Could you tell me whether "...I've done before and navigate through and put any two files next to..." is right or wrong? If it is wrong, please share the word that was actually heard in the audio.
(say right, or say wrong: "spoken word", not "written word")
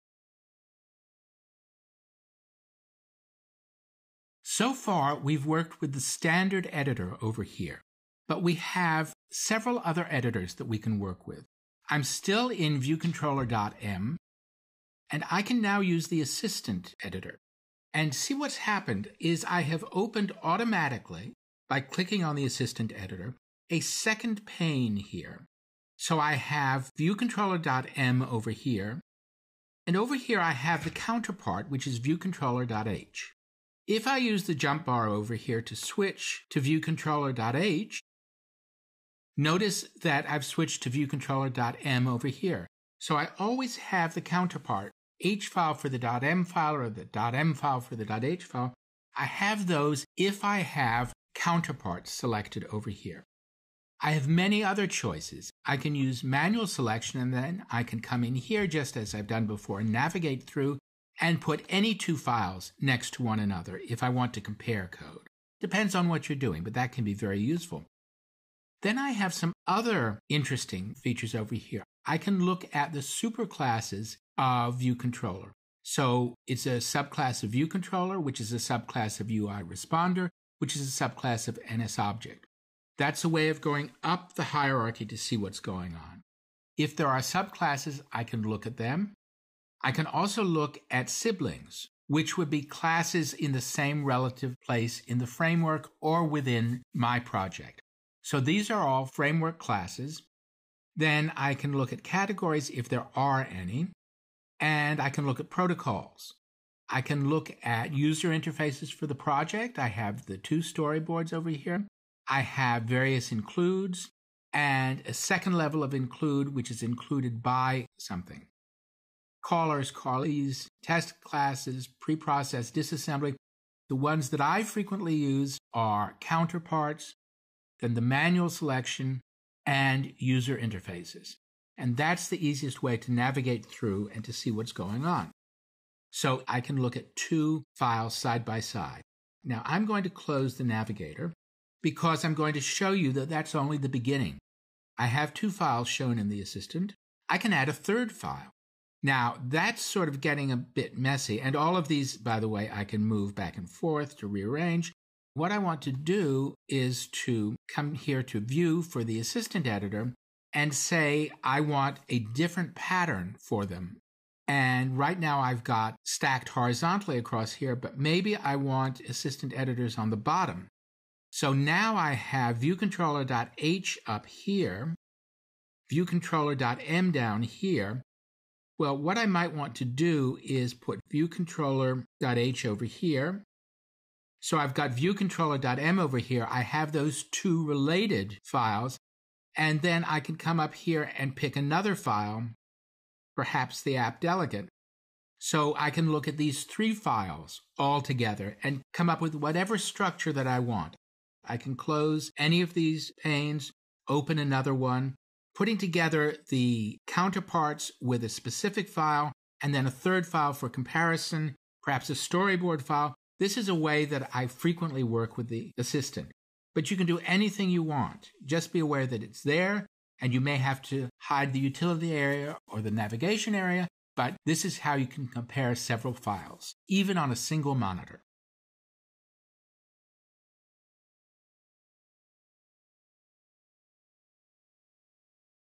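right.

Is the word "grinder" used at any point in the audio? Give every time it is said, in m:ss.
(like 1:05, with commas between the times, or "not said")
not said.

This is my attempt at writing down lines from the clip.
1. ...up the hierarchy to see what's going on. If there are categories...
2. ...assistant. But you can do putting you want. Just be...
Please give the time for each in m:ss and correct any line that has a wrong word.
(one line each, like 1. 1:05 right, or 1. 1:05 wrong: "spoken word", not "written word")
1. 1:24 wrong: "subclasses", not "categories"
2. 3:35 wrong: "anything", not "putting".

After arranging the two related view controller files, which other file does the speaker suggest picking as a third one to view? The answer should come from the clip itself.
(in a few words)
the app delegate.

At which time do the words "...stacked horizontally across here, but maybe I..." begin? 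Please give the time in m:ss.
2:46.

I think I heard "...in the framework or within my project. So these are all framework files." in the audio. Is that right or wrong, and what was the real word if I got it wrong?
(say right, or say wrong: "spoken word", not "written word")
wrong: "classes", not "files".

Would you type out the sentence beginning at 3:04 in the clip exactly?
So I've got viewcontroller.m over here.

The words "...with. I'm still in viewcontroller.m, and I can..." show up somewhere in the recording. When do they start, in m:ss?
0:11.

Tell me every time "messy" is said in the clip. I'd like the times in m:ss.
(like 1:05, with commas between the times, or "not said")
2:30.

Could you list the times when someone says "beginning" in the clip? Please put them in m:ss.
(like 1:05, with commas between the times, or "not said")
2:23.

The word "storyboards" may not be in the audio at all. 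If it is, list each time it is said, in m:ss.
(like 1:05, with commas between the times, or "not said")
1:50, 3:32.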